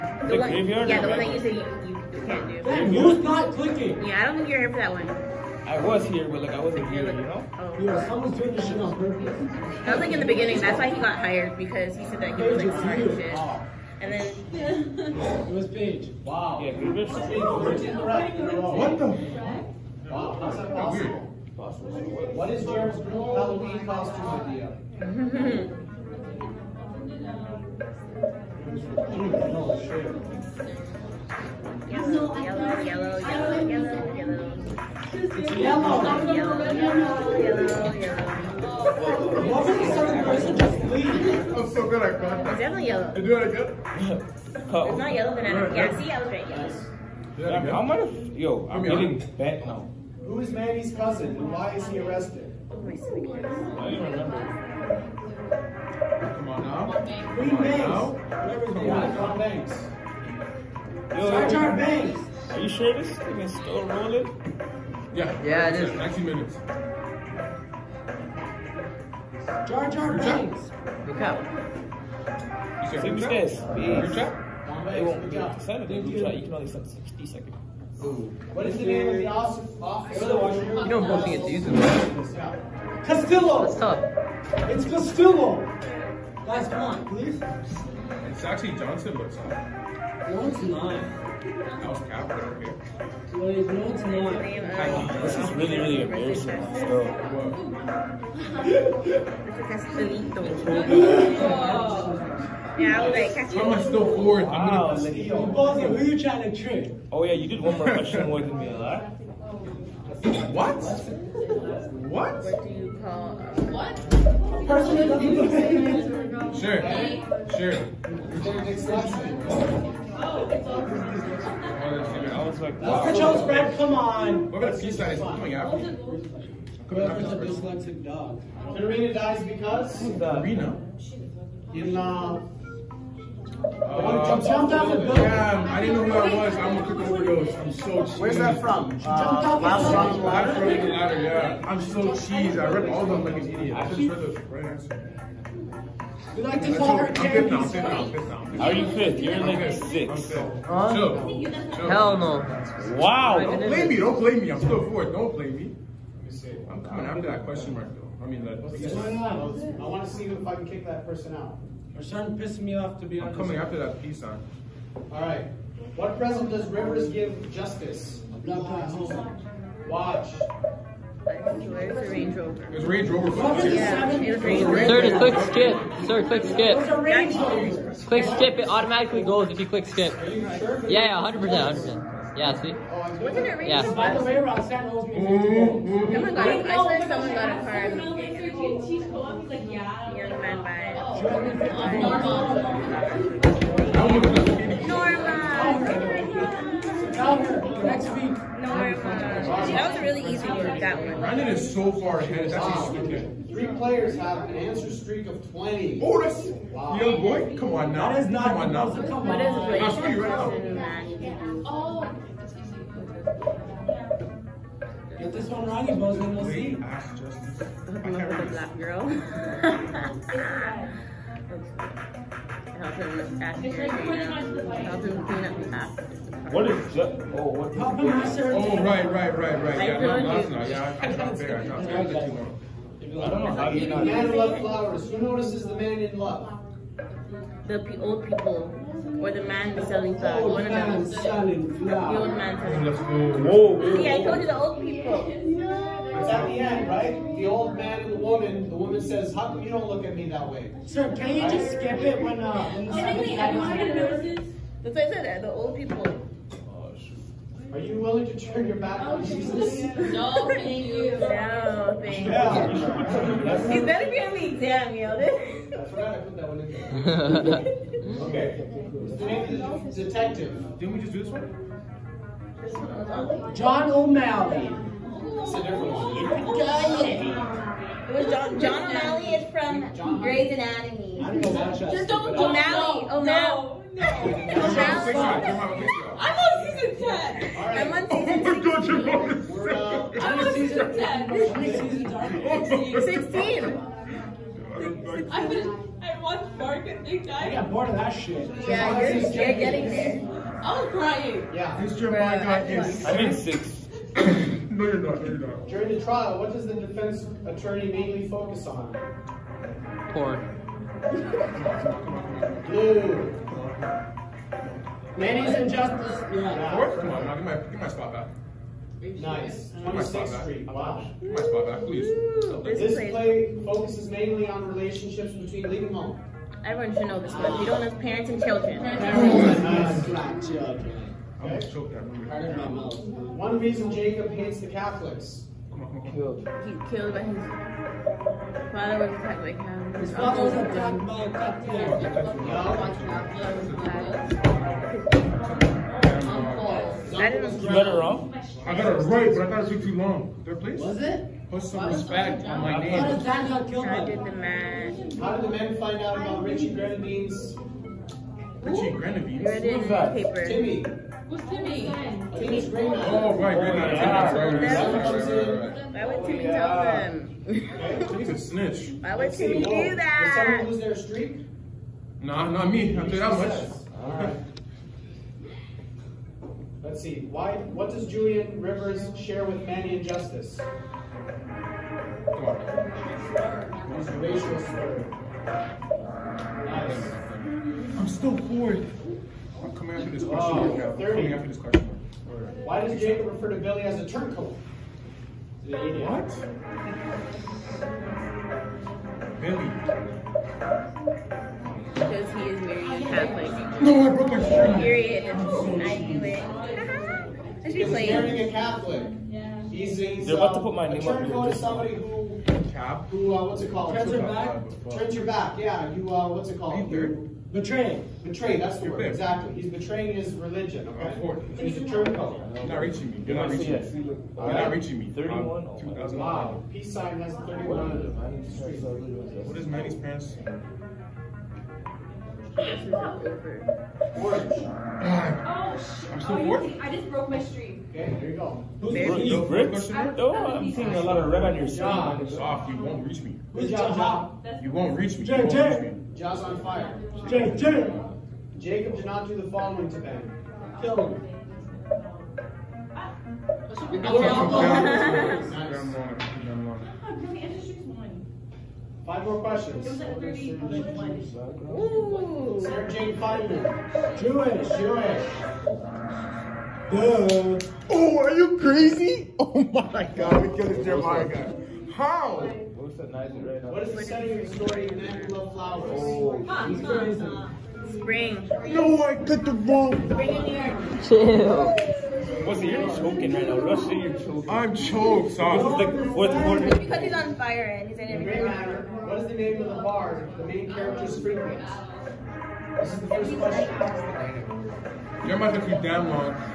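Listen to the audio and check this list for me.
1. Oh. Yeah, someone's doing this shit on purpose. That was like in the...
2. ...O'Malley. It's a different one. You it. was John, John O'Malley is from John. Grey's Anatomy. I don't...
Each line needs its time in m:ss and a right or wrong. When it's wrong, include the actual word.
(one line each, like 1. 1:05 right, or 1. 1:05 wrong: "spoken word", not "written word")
1. 0:07 right
2. 4:33 right.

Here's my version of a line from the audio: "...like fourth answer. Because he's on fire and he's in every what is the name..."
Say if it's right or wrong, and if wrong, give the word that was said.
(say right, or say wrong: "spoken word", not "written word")
wrong: "quarter", not "answer".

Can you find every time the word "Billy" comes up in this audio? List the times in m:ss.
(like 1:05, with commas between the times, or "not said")
6:33, 6:39.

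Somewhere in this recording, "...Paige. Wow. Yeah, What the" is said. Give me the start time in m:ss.
0:15.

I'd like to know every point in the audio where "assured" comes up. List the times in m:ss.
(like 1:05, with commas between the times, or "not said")
not said.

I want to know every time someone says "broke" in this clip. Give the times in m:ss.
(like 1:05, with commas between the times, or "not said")
6:44, 7:17.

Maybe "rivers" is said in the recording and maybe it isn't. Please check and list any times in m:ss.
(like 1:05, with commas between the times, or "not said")
2:46, 6:18.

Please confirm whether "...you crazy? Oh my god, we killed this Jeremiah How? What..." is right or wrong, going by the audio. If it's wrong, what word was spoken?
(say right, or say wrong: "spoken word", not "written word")
right.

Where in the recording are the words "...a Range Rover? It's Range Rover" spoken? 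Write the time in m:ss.
2:51.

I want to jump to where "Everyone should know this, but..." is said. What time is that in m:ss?
5:26.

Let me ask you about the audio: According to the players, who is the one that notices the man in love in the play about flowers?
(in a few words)
The old man selling flowers.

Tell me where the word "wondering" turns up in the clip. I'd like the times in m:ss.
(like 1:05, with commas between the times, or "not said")
not said.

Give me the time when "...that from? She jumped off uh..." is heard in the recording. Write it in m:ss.
2:18.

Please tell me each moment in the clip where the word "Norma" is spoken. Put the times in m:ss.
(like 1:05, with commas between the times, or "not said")
3:11, 3:18.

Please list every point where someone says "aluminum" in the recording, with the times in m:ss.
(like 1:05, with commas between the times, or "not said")
not said.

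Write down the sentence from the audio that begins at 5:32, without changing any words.
One reason Jacob hates the Catholics.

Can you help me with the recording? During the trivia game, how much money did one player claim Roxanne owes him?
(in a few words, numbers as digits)
50.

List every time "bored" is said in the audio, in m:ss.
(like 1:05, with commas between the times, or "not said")
4:57, 6:28.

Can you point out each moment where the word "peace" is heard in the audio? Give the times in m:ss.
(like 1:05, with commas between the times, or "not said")
2:04, 2:44, 7:06.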